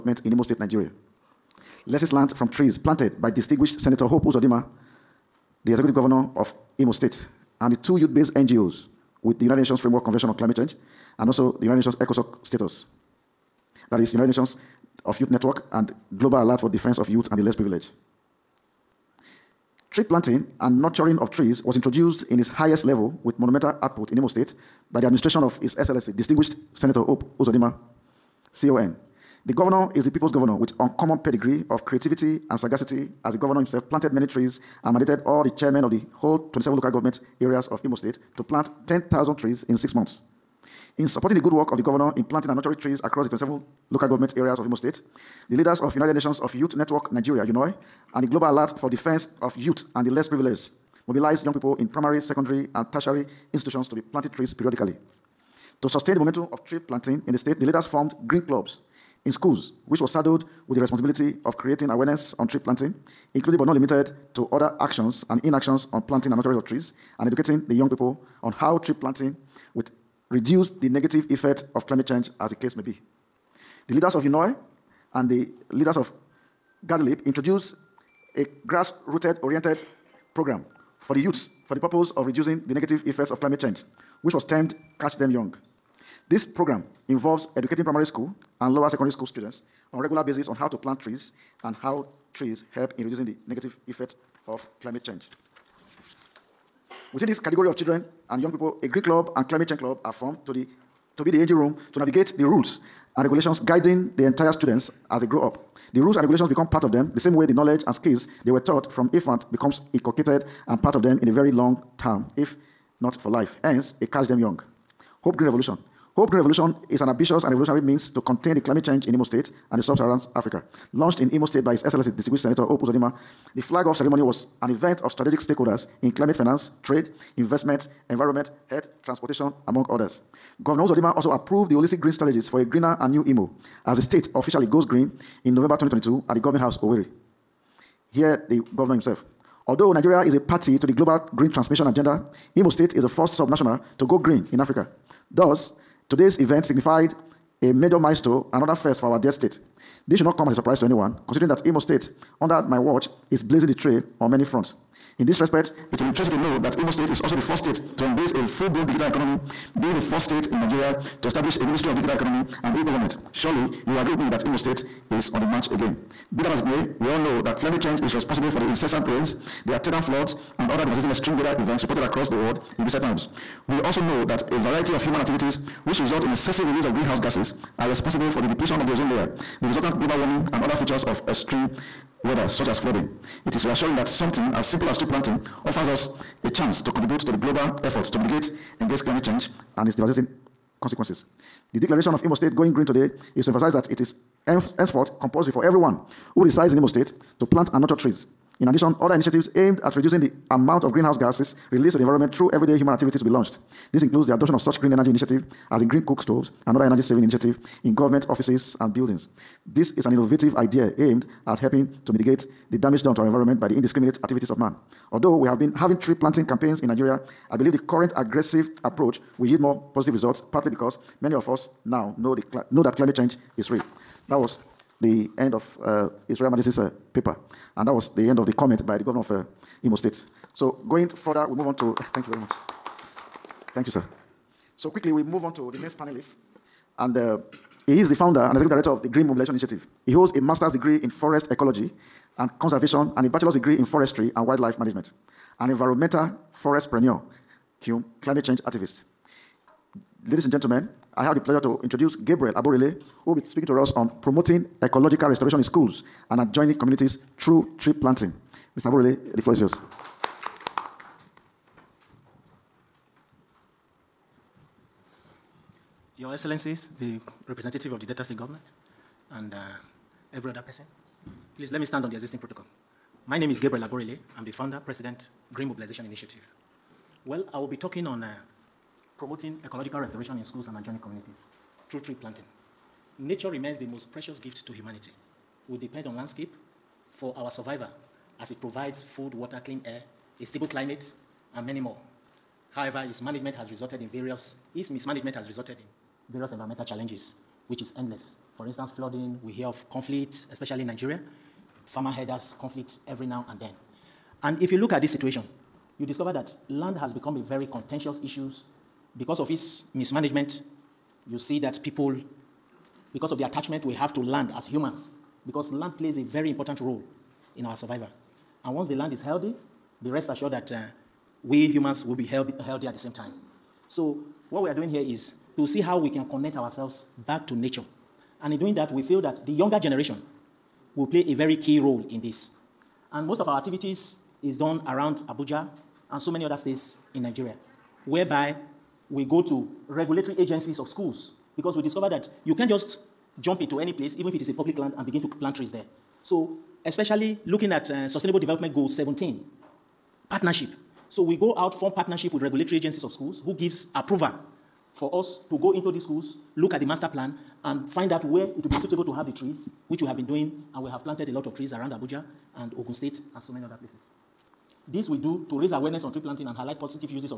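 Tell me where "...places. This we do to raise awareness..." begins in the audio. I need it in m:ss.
6:03.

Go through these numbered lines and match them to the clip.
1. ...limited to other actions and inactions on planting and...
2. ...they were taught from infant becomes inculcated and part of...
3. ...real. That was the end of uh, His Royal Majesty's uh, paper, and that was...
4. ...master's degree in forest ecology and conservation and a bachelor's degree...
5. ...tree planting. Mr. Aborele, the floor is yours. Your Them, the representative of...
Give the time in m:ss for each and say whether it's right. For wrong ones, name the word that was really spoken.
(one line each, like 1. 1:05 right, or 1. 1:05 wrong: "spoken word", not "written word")
1. 1:03 right
2. 1:48 right
3. 3:43 right
4. 4:00 right
5. 4:17 wrong: "Excellencies", not "Them".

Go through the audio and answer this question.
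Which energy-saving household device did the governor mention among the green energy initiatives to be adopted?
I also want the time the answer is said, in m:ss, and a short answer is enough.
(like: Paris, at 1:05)
green cook stoves, at 3:25.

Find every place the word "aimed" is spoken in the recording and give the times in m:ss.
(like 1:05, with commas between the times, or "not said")
3:19, 3:30.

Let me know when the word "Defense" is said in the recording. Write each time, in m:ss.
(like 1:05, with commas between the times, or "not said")
0:16, 0:48.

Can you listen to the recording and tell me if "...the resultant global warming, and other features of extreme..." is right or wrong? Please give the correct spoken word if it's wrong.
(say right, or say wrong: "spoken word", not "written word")
right.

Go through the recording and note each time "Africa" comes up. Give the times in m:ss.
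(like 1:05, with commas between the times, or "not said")
2:00, 2:24.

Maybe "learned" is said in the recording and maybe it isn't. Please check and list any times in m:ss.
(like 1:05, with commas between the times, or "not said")
0:02.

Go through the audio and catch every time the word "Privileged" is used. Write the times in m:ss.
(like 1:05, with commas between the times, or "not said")
0:17, 0:50.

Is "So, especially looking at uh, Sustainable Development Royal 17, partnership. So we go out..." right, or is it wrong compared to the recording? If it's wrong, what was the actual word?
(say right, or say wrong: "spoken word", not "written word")
wrong: "Goal", not "Royal".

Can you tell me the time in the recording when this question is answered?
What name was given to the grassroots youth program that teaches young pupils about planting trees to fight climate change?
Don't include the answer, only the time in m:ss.
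1:24.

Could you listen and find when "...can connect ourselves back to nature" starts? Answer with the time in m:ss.
5:26.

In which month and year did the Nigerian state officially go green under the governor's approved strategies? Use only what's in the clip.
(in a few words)
November 2022.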